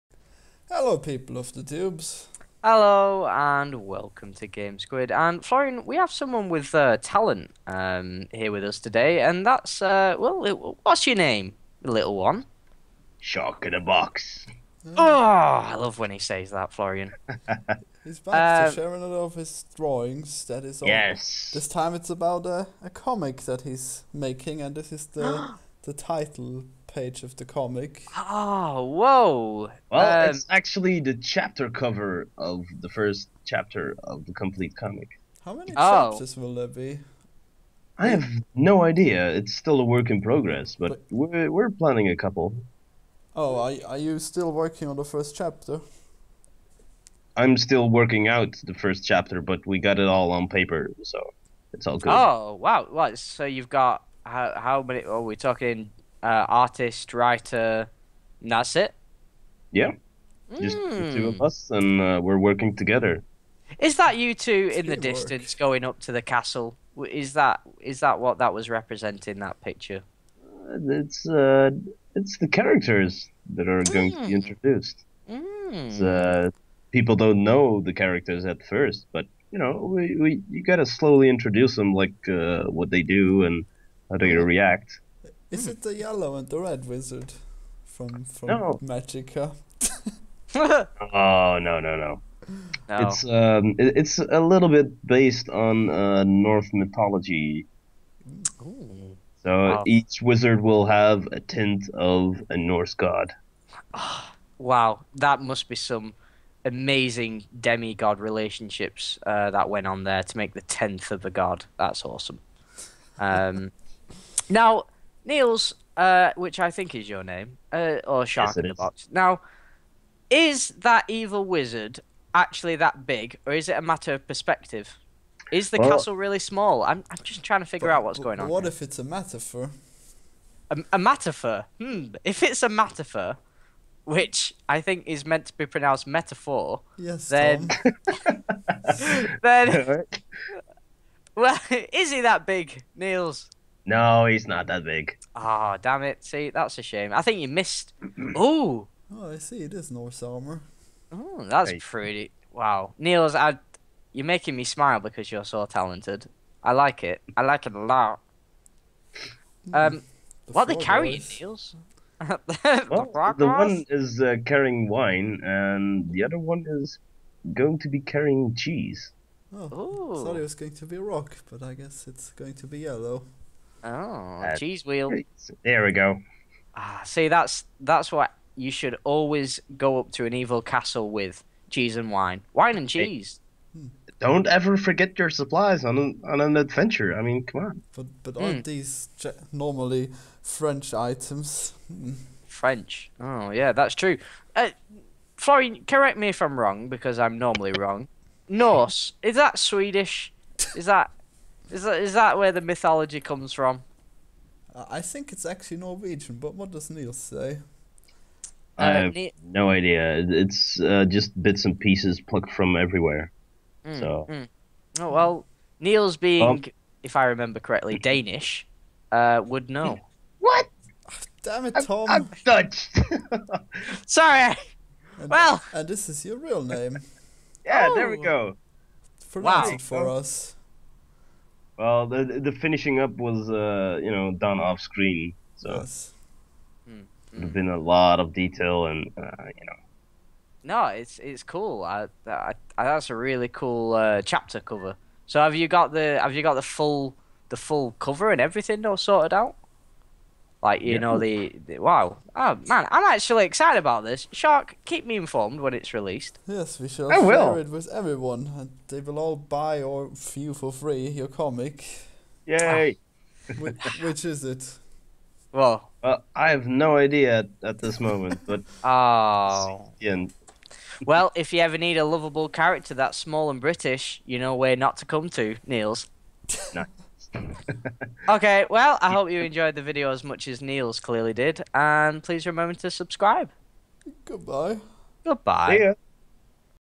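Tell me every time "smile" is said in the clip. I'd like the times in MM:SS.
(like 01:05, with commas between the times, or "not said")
02:34.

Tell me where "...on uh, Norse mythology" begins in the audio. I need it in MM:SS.
01:35.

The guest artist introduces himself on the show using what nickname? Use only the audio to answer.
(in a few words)
Shark in a box.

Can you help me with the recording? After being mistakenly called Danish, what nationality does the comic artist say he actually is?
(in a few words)
Dutch.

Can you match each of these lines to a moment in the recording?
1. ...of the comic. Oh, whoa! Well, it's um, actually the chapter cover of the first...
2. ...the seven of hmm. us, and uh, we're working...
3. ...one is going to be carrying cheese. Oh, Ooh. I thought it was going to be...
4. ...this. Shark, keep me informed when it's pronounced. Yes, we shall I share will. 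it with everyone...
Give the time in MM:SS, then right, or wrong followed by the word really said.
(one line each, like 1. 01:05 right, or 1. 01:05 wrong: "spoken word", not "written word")
1. 00:27 right
2. 01:00 wrong: "two", not "seven"
3. 02:46 right
4. 04:14 wrong: "released", not "pronounced".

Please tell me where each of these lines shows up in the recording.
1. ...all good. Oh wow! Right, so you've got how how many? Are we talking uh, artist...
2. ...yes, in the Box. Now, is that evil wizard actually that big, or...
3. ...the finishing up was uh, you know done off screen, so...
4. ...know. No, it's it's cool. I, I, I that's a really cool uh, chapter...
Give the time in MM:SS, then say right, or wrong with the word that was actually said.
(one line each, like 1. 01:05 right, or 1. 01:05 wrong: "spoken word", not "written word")
1. 00:51 right
2. 01:58 right
3. 03:52 right
4. 03:59 right.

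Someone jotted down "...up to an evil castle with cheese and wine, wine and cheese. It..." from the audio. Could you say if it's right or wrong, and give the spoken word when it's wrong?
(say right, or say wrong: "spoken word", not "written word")
right.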